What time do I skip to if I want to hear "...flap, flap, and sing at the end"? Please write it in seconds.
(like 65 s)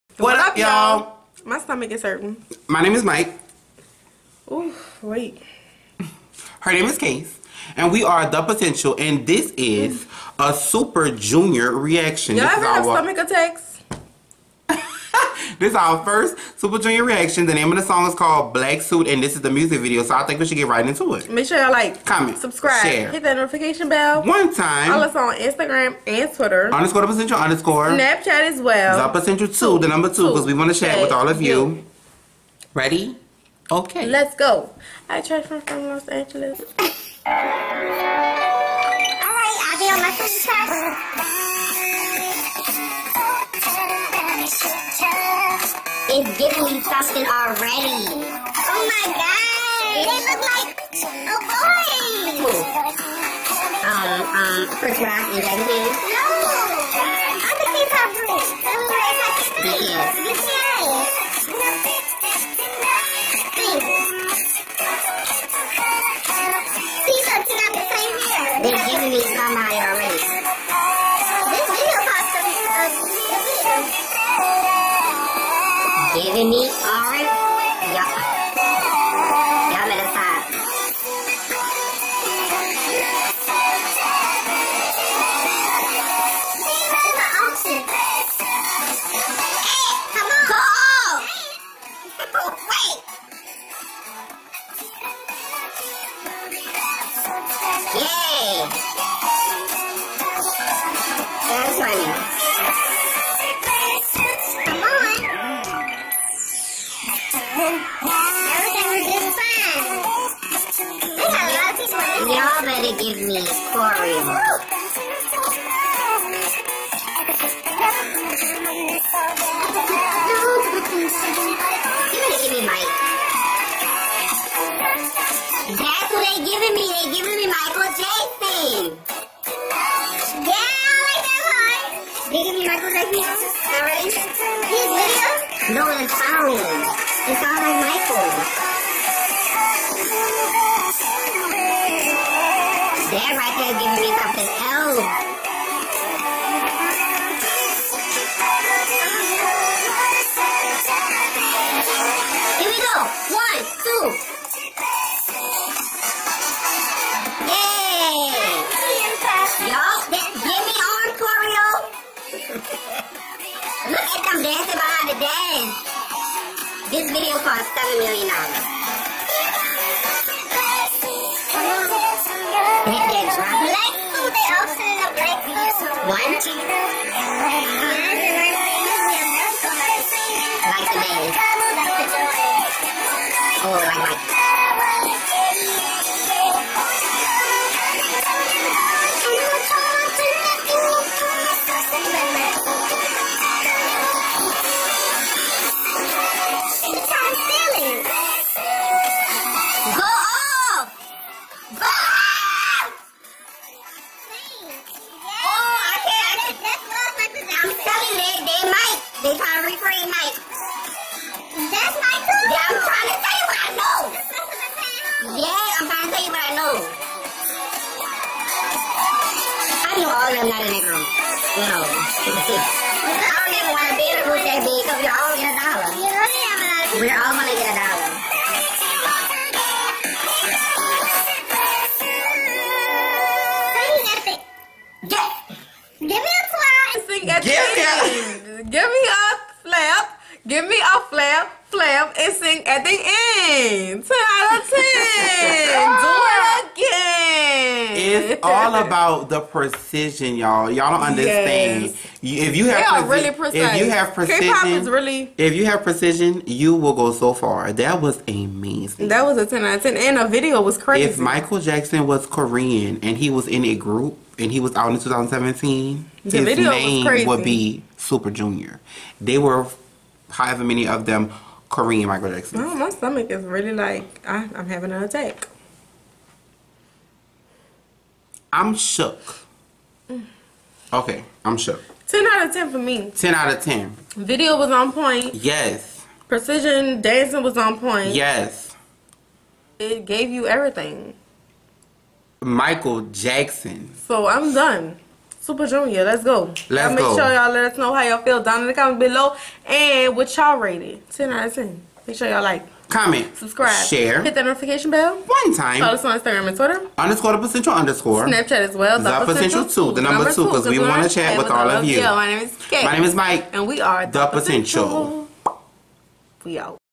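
241 s.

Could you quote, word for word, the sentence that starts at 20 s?
So I think we should get right into it.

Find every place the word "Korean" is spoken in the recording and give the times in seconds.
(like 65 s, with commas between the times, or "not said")
262 s, 271 s.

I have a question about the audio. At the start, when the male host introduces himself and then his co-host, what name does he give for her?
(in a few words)
Kayce.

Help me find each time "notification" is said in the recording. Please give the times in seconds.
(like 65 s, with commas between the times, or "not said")
23 s, 304 s.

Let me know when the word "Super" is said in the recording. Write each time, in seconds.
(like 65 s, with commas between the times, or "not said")
10 s, 16 s, 268 s, 295 s.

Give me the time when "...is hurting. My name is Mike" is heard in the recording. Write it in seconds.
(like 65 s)
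1 s.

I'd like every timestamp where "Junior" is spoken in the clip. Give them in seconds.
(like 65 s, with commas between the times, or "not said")
11 s, 16 s, 268 s, 295 s.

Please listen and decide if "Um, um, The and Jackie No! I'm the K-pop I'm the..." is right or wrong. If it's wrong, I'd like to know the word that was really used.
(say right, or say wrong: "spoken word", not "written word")
wrong: "Rock", not "The".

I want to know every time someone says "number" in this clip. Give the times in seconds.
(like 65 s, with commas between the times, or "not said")
29 s, 310 s.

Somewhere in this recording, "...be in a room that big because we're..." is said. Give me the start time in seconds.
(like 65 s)
224 s.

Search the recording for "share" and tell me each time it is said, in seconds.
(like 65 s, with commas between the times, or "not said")
22 s, 30 s, 303 s.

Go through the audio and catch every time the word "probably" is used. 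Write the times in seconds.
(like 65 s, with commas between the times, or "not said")
not said.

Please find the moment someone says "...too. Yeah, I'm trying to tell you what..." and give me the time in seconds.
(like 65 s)
212 s.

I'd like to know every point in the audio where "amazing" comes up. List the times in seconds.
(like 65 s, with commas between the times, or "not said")
258 s.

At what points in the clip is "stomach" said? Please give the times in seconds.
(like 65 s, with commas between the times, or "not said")
1 s, 12 s, 272 s.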